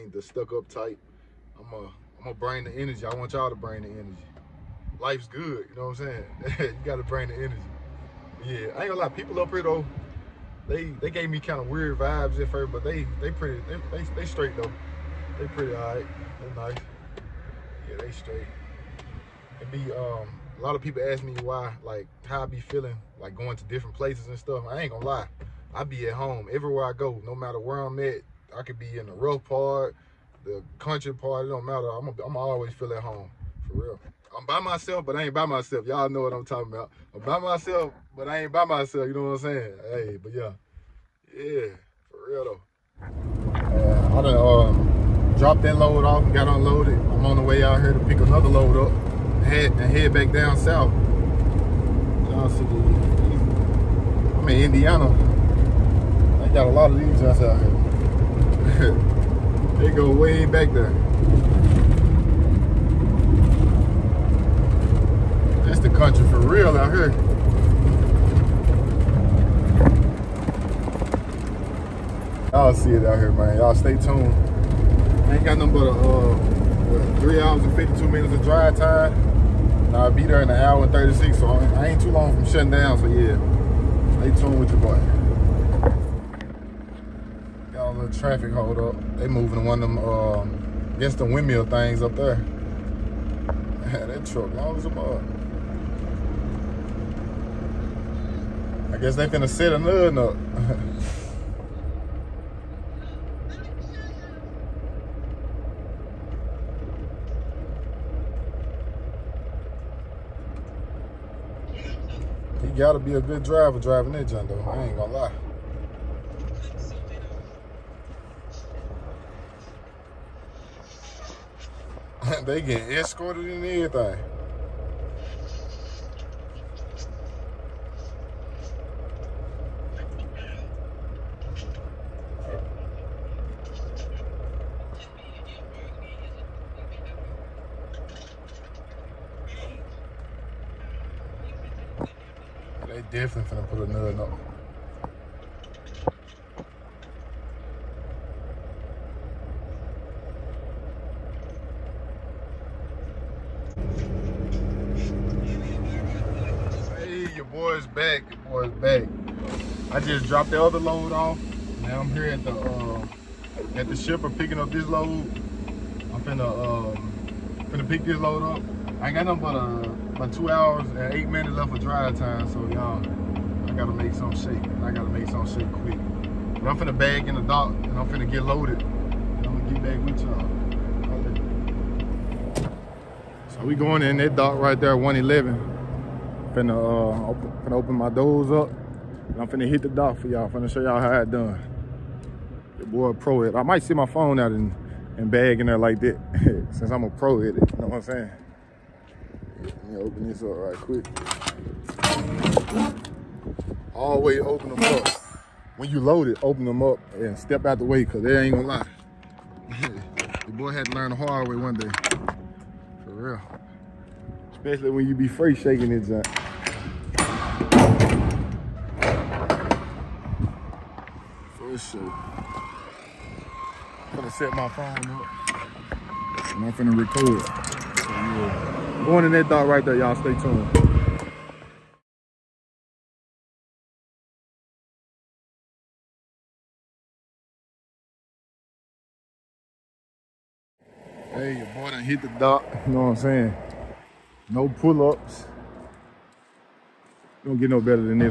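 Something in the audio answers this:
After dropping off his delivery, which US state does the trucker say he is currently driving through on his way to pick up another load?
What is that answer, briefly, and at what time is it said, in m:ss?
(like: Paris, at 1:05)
Indiana, at 0:54.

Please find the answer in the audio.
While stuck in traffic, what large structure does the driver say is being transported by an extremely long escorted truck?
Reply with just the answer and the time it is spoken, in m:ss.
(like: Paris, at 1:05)
windmill, at 1:31.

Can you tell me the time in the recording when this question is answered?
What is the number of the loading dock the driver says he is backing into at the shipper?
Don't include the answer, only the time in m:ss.
3:04.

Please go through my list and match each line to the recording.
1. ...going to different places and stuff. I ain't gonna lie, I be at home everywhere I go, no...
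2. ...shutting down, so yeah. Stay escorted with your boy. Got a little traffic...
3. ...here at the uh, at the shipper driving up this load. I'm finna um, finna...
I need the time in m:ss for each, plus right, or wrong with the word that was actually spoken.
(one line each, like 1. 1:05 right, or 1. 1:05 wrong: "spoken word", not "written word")
1. 0:23 right
2. 1:22 wrong: "tuned", not "escorted"
3. 2:42 wrong: "picking", not "driving".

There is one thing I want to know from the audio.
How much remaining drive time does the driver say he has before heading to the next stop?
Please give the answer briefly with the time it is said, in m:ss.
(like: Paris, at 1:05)
3 hours 52 minutes, at 1:17.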